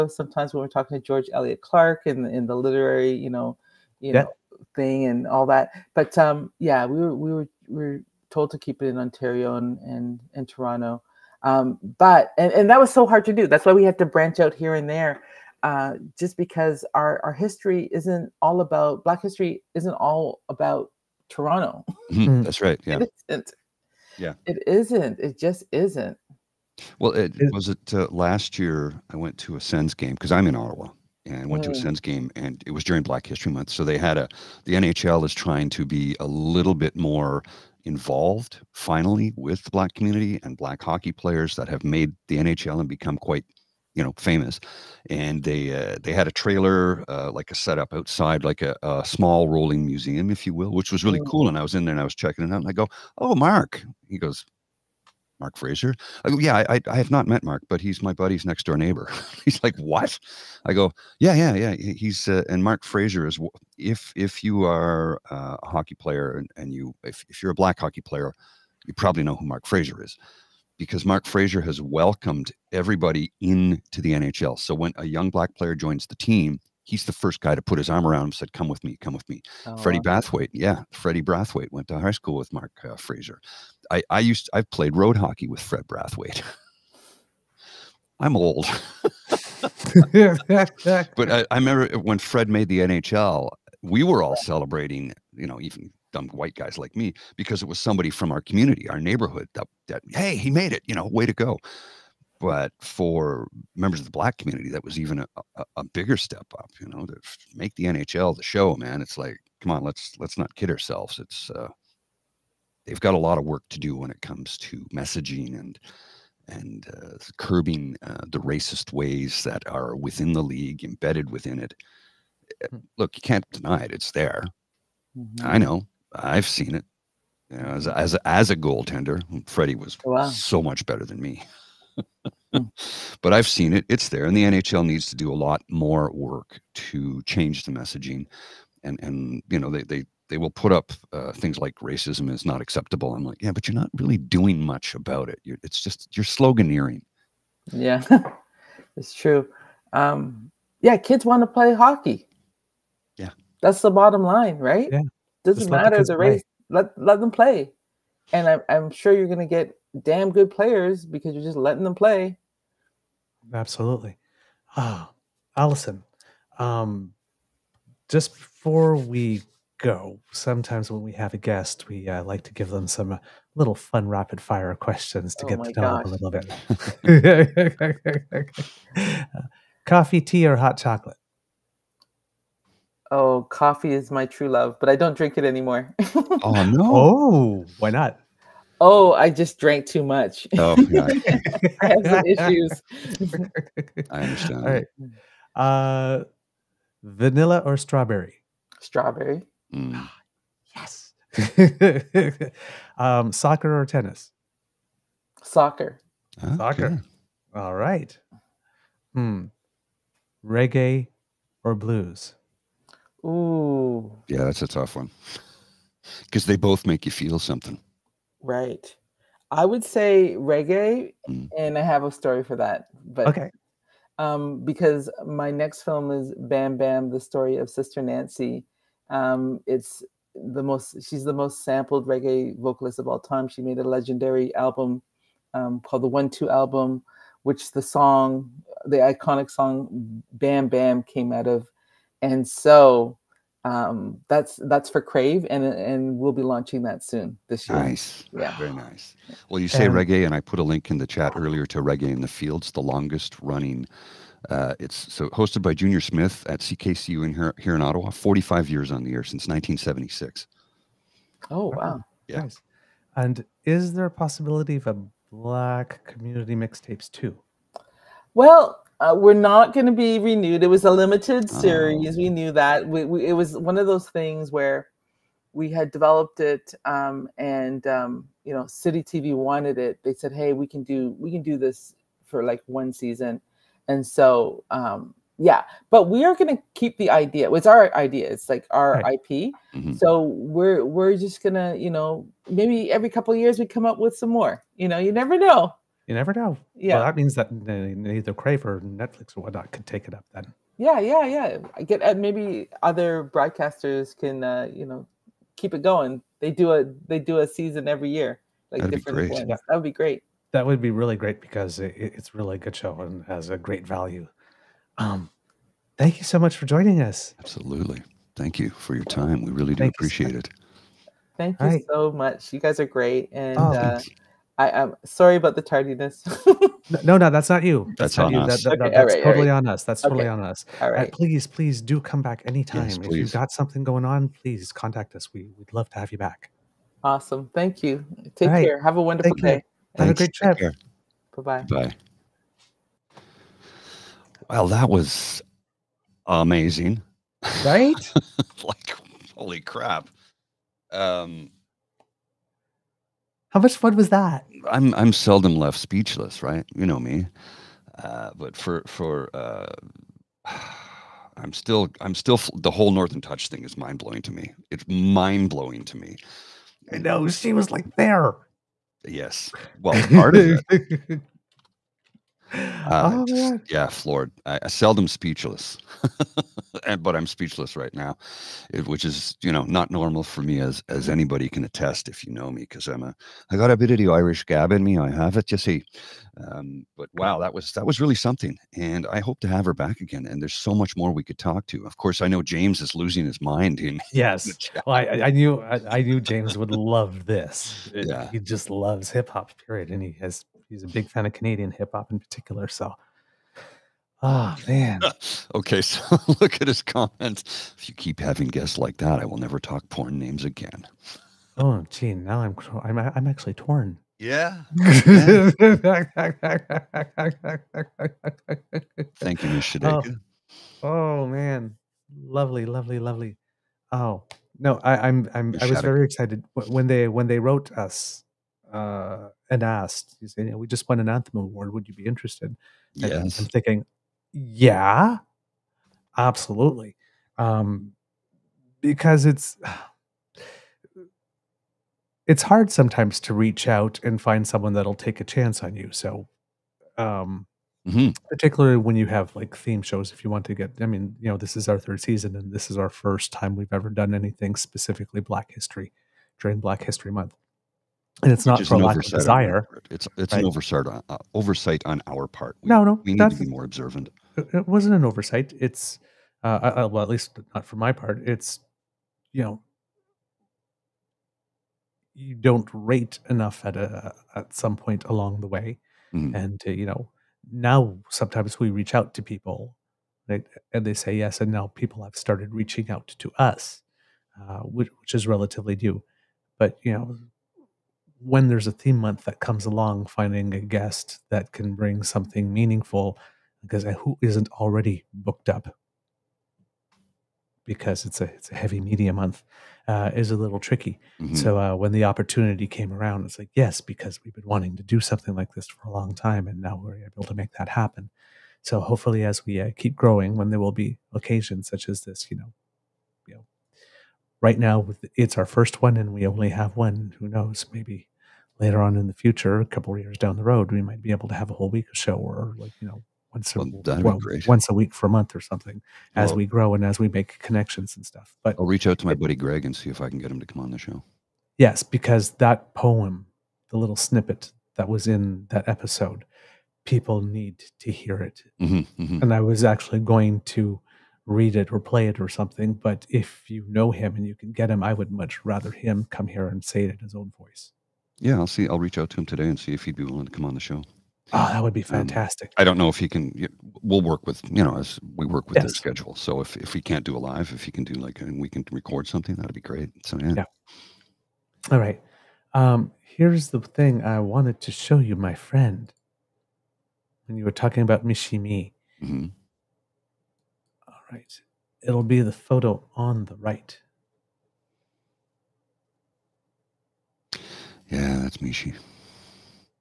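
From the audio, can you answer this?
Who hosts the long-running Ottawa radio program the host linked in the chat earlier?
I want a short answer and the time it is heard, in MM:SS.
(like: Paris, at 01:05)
Junior Smith, at 04:15.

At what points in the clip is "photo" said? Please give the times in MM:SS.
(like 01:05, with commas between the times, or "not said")
09:32.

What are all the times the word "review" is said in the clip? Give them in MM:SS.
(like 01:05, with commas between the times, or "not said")
not said.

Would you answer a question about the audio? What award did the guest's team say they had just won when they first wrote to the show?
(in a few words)
Anthem Award.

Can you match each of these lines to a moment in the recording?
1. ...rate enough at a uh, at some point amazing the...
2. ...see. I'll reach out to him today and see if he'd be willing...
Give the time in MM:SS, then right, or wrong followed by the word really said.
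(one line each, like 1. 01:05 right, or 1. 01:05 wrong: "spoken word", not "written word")
1. 07:52 wrong: "along", not "amazing"
2. 09:08 right.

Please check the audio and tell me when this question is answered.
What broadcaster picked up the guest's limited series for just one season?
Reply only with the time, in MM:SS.
04:38.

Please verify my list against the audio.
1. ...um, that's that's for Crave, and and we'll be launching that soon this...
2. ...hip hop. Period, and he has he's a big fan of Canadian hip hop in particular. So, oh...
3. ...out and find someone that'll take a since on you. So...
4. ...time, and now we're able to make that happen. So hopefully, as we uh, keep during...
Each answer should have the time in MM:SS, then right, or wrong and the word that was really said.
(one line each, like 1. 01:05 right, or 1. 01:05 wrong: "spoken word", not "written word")
1. 04:03 right
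2. 06:39 right
3. 07:23 wrong: "chance", not "since"
4. 08:26 wrong: "growing", not "during".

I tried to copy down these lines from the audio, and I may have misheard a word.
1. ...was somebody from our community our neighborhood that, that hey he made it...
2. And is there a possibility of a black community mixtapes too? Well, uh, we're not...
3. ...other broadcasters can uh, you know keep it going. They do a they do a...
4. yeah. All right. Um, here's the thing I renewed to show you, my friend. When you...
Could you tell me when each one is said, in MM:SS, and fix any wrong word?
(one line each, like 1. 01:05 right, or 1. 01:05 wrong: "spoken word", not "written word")
1. 01:37 right
2. 04:23 right
3. 05:02 right
4. 09:20 wrong: "wanted", not "renewed".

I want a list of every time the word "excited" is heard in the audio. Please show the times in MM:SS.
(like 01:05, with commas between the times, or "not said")
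07:06.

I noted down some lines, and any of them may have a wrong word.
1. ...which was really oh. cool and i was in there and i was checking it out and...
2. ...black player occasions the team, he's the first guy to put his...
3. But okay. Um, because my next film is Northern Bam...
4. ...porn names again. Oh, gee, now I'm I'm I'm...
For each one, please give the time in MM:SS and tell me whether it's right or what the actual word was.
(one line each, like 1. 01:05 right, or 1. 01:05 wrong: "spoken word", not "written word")
1. 00:50 right
2. 01:15 wrong: "joins", not "occasions"
3. 03:43 wrong: "Bam", not "Northern"
4. 06:49 right.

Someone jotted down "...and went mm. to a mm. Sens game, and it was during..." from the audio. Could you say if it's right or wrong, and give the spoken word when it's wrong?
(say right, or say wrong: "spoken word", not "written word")
right.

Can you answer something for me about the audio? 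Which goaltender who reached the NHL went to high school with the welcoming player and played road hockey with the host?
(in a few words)
Freddie Brathwaite.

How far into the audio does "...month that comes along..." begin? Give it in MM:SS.
08:08.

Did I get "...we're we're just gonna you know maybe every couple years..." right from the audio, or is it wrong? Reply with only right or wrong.
right.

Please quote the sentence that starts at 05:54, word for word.
I'm I'm seldom left speechless, right?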